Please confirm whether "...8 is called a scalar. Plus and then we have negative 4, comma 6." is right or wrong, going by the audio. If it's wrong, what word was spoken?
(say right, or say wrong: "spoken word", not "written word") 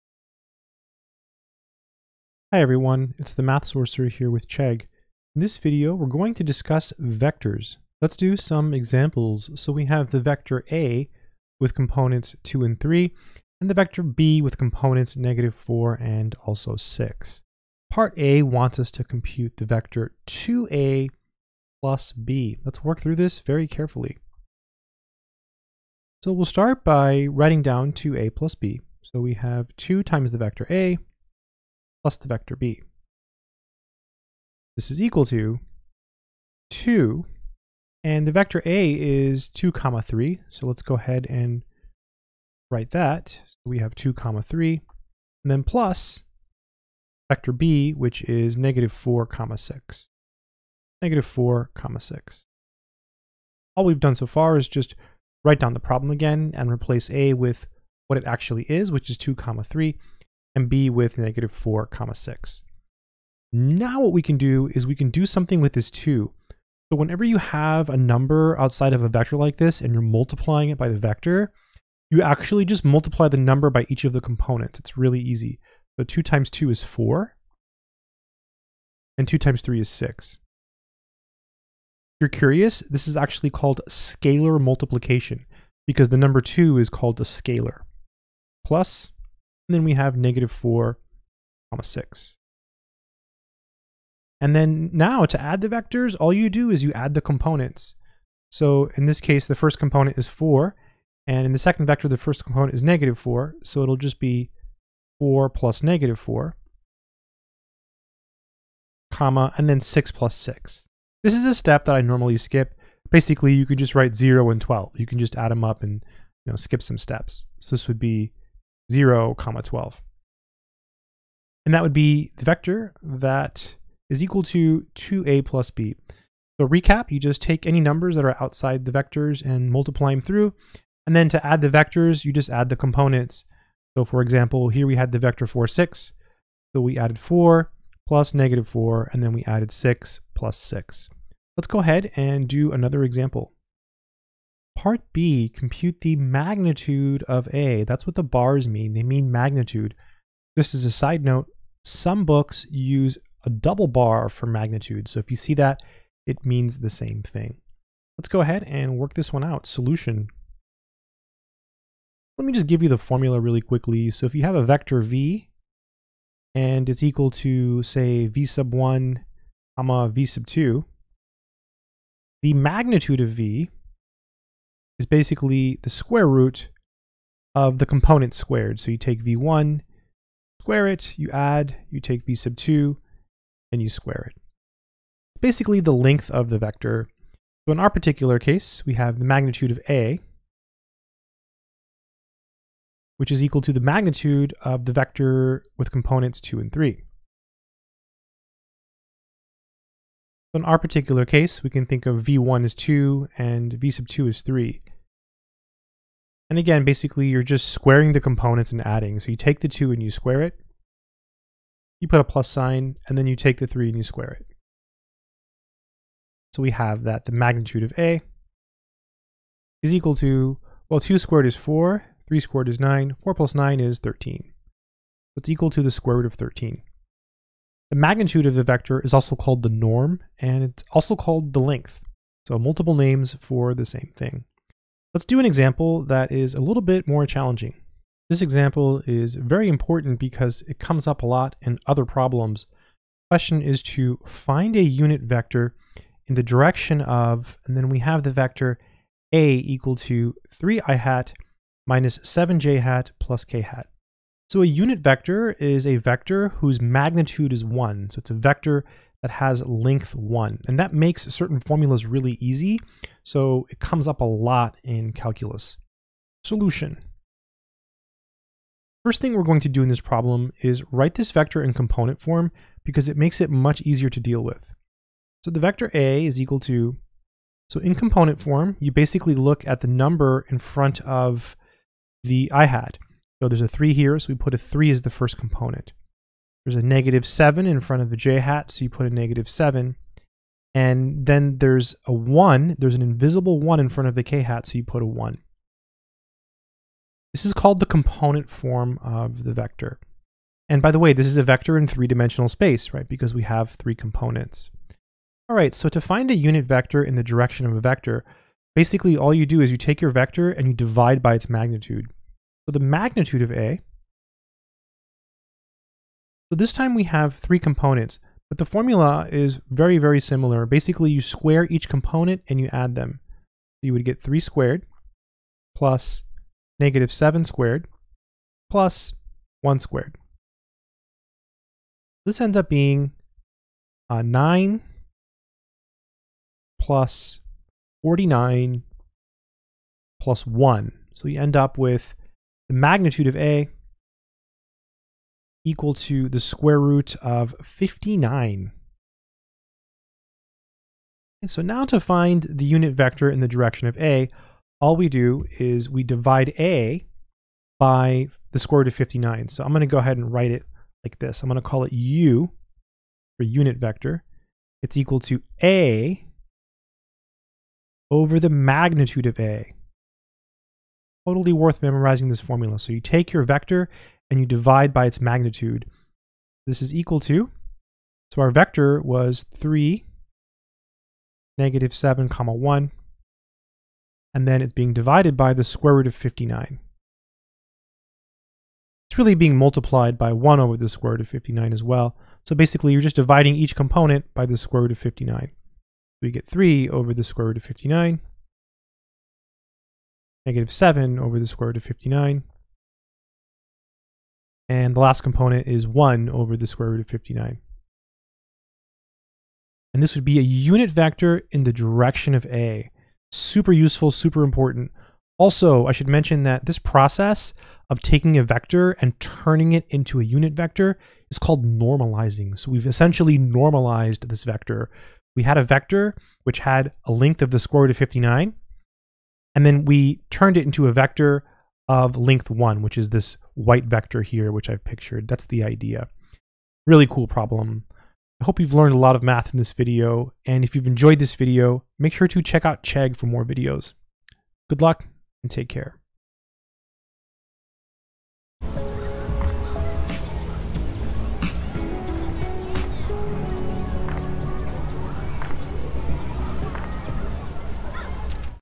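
wrong: "2", not "8".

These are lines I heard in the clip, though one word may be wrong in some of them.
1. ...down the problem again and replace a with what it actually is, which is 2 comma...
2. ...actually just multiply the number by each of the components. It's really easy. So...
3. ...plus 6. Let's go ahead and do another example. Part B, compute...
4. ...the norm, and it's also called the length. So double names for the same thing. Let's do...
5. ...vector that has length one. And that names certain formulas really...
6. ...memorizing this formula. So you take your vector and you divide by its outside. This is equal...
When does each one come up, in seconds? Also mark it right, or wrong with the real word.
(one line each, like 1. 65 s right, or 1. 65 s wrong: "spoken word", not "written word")
1. 55 s right
2. 72 s right
3. 140 s right
4. 229 s wrong: "multiple", not "double"
5. 258 s wrong: "makes", not "names"
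6. 371 s wrong: "magnitude", not "outside".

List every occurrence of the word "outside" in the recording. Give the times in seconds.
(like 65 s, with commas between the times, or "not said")
68 s, 128 s.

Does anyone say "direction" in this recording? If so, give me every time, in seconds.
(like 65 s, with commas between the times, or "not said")
246 s, 307 s, 353 s, 411 s.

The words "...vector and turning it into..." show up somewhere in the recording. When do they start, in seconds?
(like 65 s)
418 s.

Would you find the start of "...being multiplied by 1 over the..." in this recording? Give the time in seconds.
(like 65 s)
389 s.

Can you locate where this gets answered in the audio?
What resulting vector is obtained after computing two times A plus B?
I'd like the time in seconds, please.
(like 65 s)
118 s.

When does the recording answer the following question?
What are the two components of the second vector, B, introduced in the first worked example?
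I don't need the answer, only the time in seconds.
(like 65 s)
15 s.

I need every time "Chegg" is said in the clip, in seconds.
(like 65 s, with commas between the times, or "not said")
4 s, 442 s.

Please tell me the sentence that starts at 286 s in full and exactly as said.
There's a negative 7 in front of the j hat, so you put a negative 7.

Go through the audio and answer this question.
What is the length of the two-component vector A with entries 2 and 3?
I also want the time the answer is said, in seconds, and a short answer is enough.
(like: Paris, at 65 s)
square root of 13, at 225 s.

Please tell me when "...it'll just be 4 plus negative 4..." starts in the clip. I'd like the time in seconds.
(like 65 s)
103 s.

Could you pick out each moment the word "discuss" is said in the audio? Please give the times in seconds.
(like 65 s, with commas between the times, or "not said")
6 s.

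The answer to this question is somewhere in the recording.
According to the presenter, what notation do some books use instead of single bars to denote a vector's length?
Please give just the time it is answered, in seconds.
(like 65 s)
153 s.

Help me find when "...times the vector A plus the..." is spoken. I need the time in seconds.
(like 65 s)
30 s.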